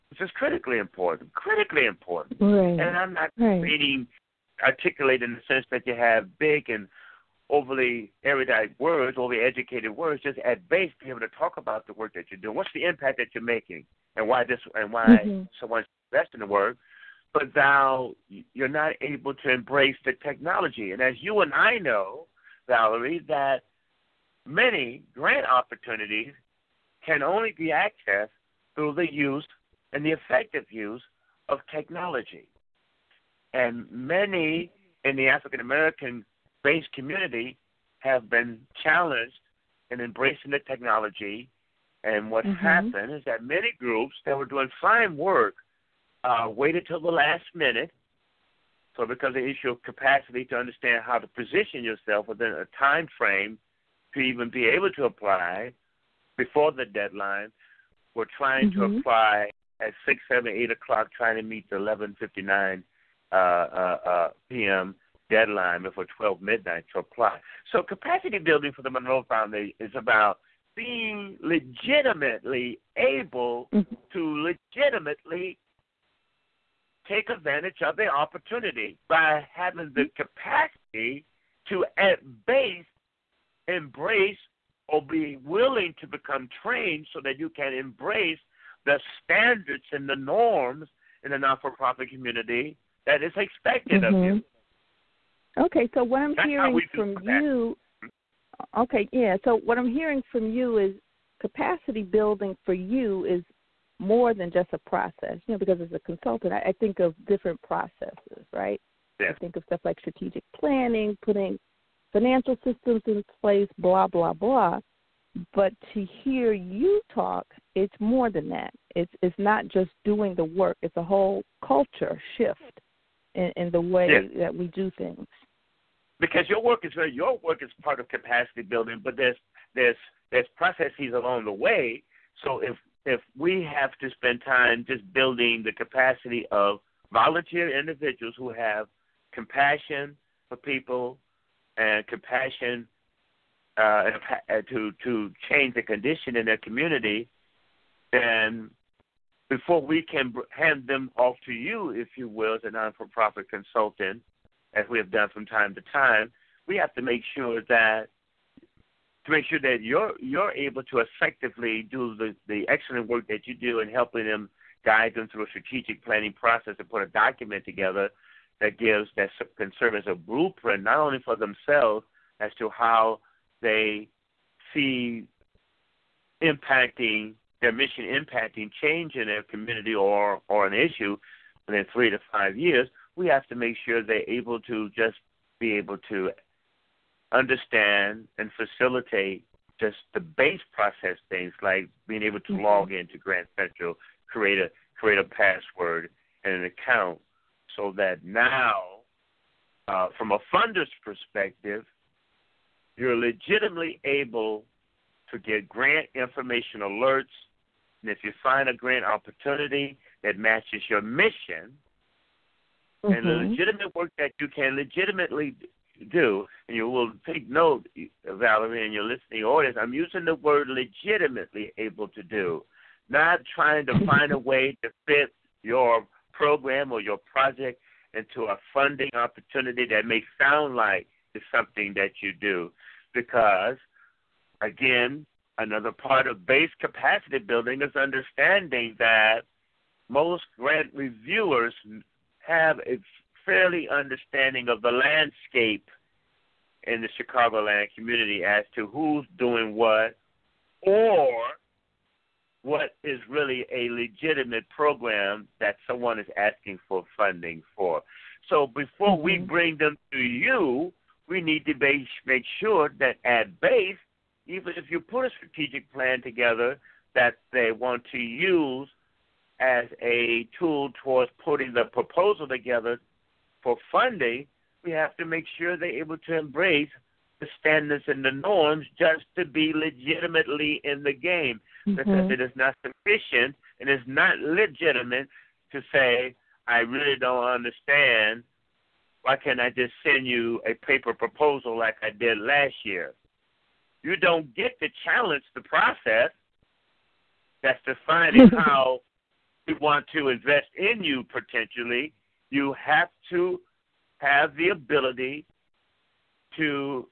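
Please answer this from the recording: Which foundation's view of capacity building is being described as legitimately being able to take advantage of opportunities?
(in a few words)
Monroe Foundation.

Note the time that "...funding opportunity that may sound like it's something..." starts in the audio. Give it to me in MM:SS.
03:48.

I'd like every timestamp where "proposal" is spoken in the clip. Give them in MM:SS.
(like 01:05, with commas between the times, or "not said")
04:31, 04:51.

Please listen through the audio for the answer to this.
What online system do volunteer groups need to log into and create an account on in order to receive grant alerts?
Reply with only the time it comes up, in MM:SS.
03:13.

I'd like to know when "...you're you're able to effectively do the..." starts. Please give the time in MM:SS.
02:39.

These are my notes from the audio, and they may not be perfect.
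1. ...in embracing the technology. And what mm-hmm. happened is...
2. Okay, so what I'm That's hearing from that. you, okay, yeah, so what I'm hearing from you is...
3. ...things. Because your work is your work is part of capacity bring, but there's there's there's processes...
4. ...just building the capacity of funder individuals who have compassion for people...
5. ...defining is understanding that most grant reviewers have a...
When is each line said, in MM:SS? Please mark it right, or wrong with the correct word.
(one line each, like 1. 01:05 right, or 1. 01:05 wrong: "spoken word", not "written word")
1. 00:39 right
2. 01:35 right
3. 02:04 wrong: "building", not "bring"
4. 02:14 wrong: "volunteer", not "funder"
5. 03:57 wrong: "building", not "defining".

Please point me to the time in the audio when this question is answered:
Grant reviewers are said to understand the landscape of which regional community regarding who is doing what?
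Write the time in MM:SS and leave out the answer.
04:07.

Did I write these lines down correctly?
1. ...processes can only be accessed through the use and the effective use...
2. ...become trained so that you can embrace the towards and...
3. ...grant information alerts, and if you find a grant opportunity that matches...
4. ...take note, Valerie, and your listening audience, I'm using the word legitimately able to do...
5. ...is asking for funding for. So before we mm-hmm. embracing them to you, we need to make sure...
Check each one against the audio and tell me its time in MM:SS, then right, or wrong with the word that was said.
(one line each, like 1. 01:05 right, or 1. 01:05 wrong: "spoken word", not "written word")
1. 00:25 wrong: "opportunities", not "processes"
2. 01:26 wrong: "standards", not "towards"
3. 03:25 right
4. 03:37 right
5. 04:16 wrong: "bring", not "embracing".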